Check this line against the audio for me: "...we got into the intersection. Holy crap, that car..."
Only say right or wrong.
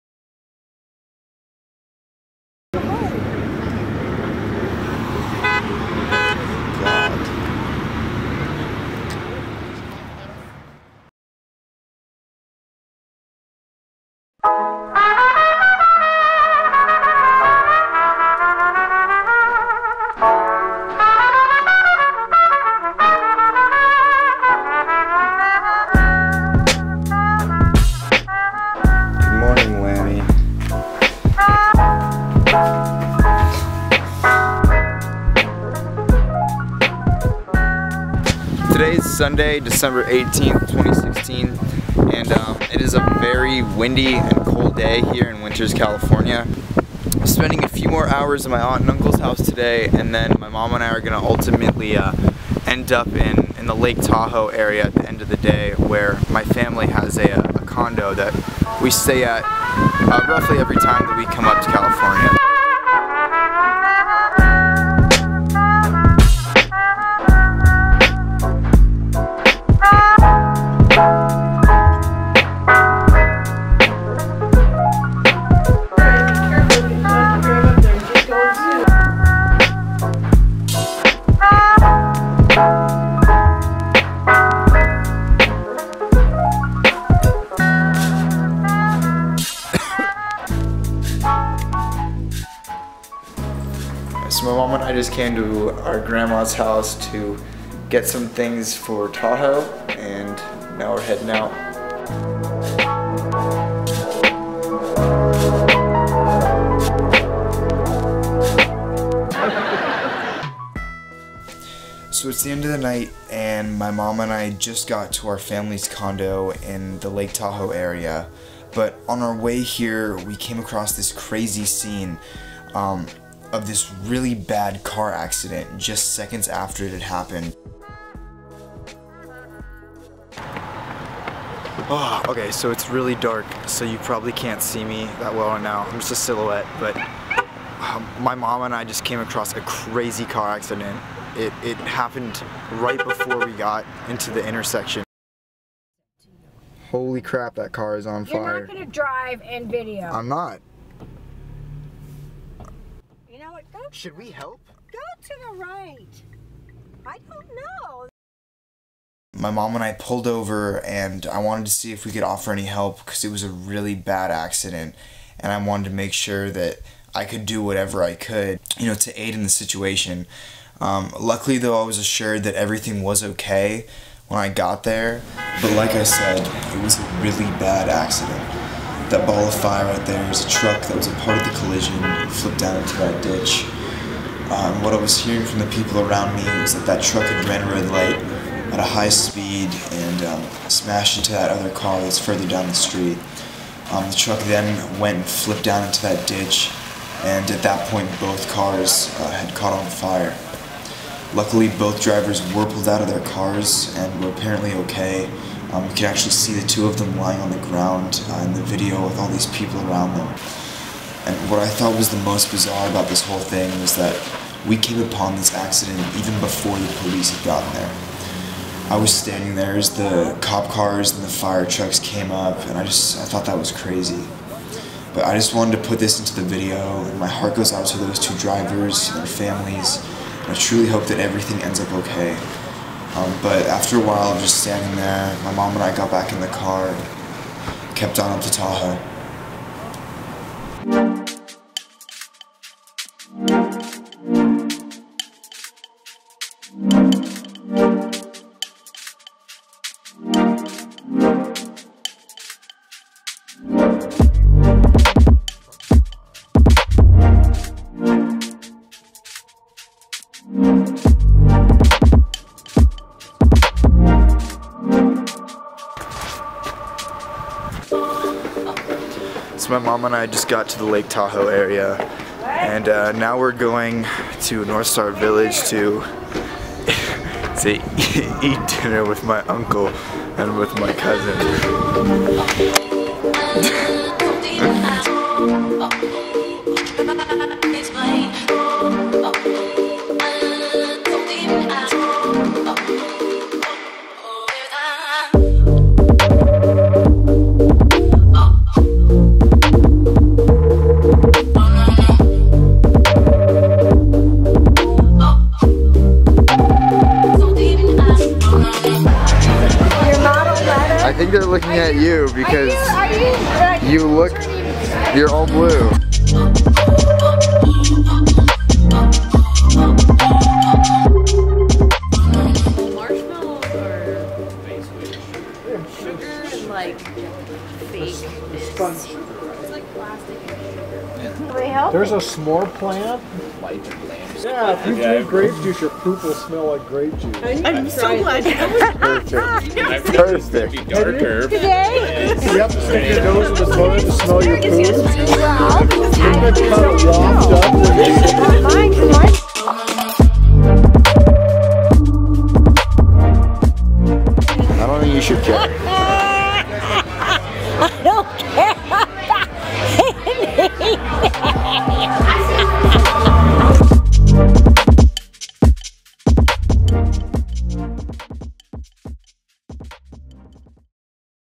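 right.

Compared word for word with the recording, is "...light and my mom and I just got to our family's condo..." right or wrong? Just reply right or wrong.
wrong.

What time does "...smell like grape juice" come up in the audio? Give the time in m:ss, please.
5:36.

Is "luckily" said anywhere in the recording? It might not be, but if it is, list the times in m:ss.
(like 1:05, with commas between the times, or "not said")
2:51, 3:21.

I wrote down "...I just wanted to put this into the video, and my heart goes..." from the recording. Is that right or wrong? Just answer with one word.
right.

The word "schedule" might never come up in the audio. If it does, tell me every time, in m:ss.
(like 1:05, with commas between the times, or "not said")
not said.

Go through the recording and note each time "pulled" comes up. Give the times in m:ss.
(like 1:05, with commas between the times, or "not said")
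2:39, 3:22.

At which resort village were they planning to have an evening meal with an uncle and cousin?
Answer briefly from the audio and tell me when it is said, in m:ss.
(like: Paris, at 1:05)
Northstar Village, at 4:34.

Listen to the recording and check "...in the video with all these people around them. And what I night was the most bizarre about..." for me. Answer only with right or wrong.
wrong.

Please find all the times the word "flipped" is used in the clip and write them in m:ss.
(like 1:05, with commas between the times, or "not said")
3:02, 3:15.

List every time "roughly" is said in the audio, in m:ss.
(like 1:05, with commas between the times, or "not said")
1:00.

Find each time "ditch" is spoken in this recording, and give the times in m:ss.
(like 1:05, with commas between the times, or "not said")
3:03, 3:16.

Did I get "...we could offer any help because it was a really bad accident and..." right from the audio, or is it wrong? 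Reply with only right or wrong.
right.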